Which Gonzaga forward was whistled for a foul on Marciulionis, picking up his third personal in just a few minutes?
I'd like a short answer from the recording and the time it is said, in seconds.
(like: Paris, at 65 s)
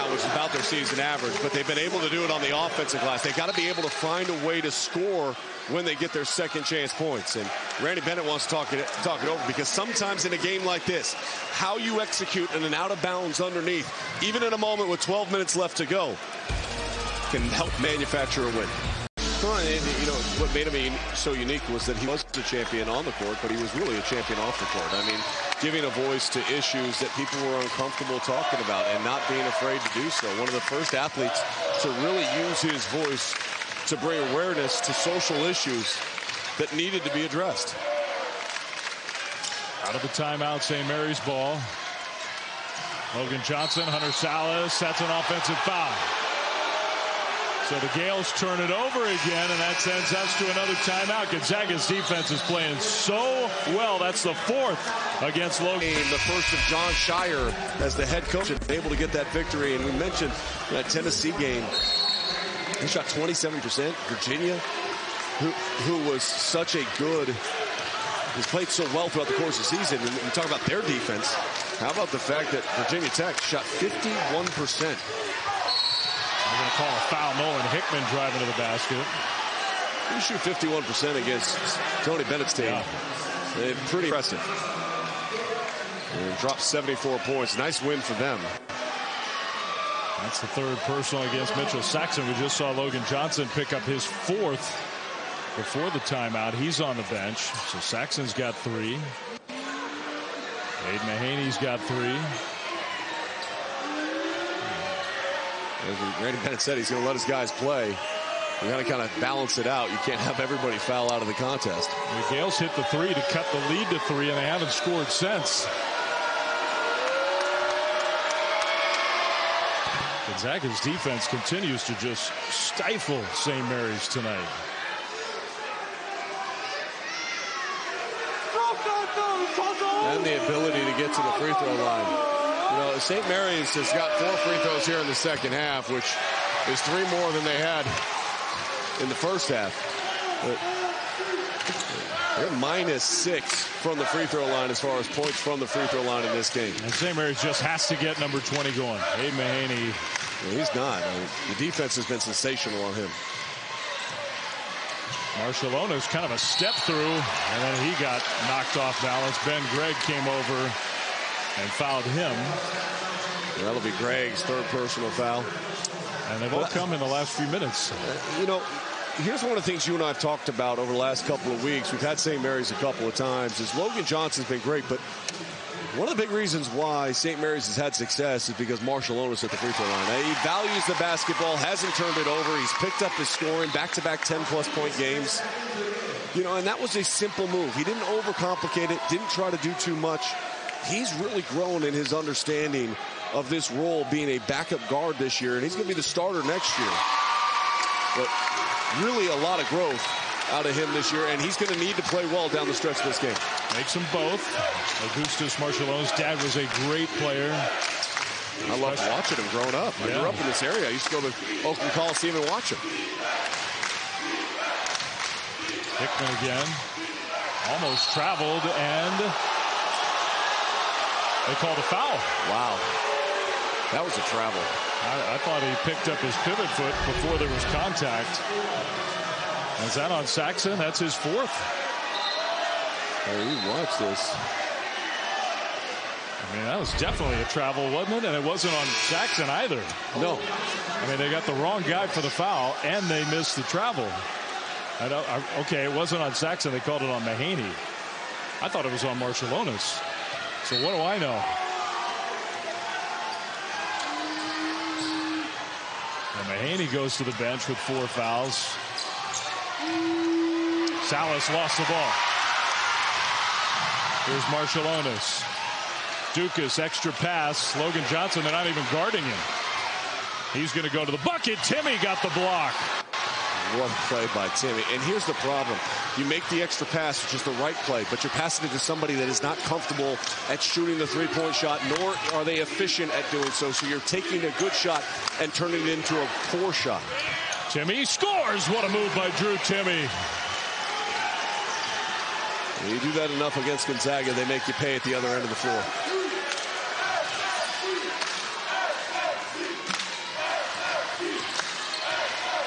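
Ben Gregg, at 159 s.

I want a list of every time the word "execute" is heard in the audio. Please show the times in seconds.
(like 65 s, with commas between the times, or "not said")
11 s.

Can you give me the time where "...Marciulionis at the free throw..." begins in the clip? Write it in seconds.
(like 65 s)
178 s.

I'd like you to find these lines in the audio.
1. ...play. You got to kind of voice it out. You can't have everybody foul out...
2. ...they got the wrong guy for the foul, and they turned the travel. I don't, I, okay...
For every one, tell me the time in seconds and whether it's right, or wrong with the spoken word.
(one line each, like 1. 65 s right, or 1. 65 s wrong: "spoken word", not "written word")
1. 107 s wrong: "balance", not "voice"
2. 241 s wrong: "missed", not "turned".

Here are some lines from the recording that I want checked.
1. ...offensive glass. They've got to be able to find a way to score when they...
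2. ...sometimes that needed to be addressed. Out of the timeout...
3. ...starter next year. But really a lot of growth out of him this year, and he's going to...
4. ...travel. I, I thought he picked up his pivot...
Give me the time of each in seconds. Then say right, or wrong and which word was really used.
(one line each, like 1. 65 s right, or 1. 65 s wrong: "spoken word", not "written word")
1. 2 s right
2. 35 s wrong: "issues", not "sometimes"
3. 196 s right
4. 224 s right.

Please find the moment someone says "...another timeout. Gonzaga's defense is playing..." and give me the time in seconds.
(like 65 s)
50 s.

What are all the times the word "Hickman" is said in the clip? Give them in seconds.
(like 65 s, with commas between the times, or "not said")
77 s, 215 s.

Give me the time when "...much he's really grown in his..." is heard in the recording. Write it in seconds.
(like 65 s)
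189 s.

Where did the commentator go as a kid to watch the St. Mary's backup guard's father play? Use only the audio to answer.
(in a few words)
Oakland Coliseum.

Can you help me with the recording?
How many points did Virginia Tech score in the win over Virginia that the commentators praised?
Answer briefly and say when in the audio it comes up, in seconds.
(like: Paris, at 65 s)
74, at 86 s.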